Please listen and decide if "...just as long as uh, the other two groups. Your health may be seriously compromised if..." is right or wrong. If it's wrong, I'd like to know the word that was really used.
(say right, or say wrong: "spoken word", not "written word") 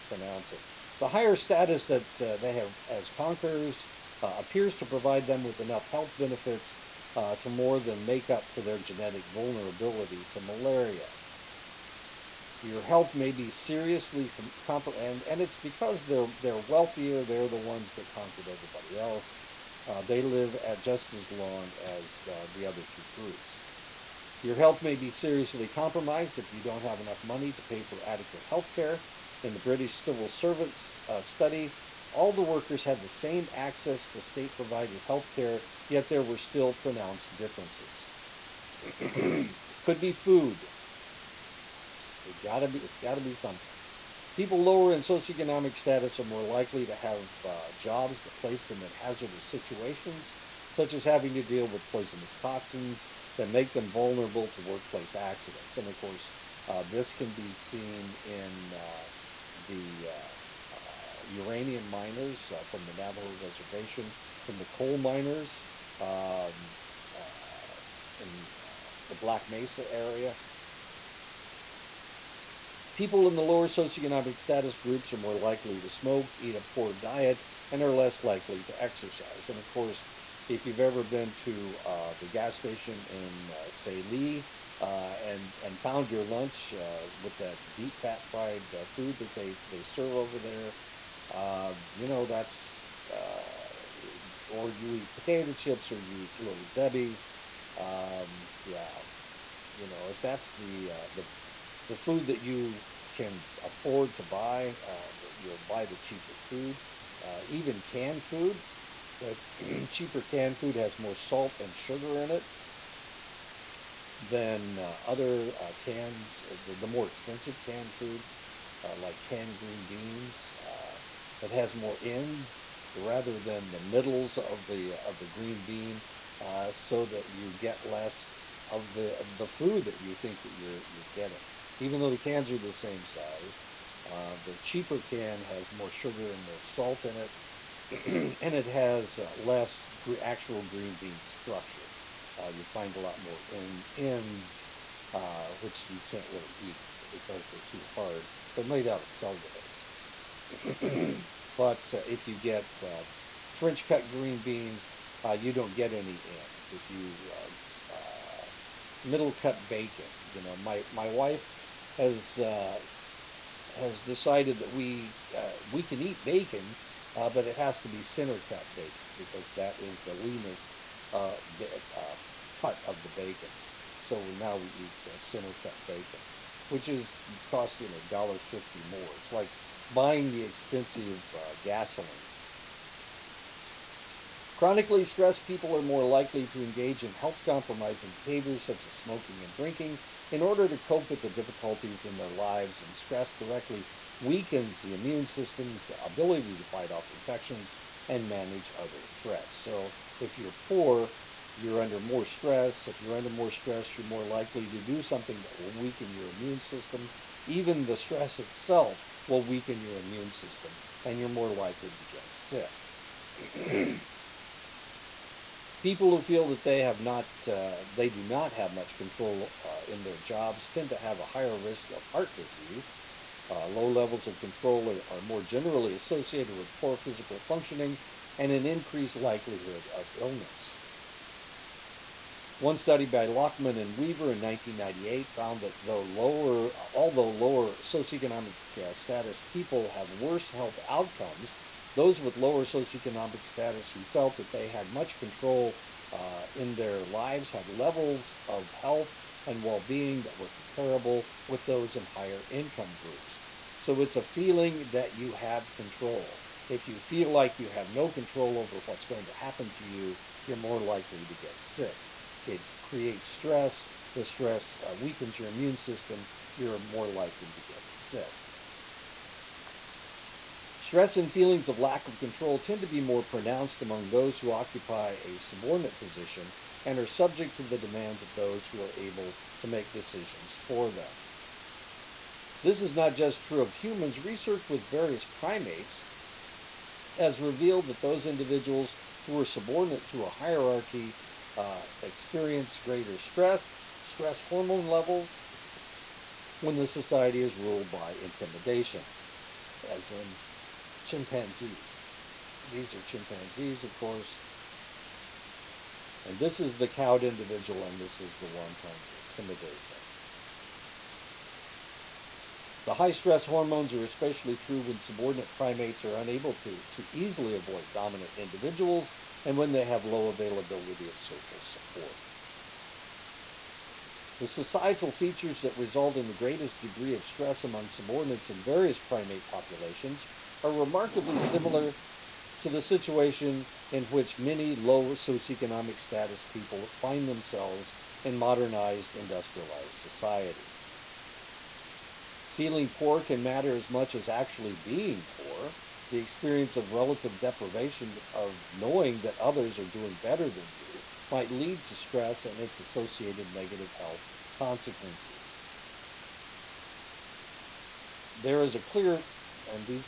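right.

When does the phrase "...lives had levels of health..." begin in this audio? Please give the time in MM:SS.
04:07.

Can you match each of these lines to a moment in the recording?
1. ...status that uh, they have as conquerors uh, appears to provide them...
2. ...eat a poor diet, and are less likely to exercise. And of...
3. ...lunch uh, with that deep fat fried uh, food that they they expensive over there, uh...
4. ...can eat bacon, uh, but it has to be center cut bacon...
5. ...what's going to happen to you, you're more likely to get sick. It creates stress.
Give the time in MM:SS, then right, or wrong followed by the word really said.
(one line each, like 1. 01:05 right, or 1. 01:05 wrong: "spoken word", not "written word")
1. 00:01 right
2. 01:16 right
3. 01:26 wrong: "serve", not "expensive"
4. 02:45 right
5. 04:18 right.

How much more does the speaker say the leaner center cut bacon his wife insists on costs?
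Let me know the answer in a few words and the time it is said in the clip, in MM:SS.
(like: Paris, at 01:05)
A dollar fifty, at 02:57.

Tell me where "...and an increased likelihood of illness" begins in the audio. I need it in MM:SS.
03:48.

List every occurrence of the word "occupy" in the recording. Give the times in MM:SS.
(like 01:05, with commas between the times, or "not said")
04:34.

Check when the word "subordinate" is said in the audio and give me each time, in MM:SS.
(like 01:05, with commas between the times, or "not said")
04:35, 04:49, 05:14, 05:27.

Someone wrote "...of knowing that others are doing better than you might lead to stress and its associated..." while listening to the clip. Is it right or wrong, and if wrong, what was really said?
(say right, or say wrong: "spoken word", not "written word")
right.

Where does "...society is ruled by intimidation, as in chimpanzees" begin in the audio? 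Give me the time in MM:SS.
04:56.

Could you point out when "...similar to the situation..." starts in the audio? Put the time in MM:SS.
05:31.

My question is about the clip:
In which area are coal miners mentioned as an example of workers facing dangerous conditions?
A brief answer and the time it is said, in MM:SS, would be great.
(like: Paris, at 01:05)
Black Mesa, at 01:09.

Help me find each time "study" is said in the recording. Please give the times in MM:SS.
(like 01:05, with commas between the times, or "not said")
00:31, 03:52.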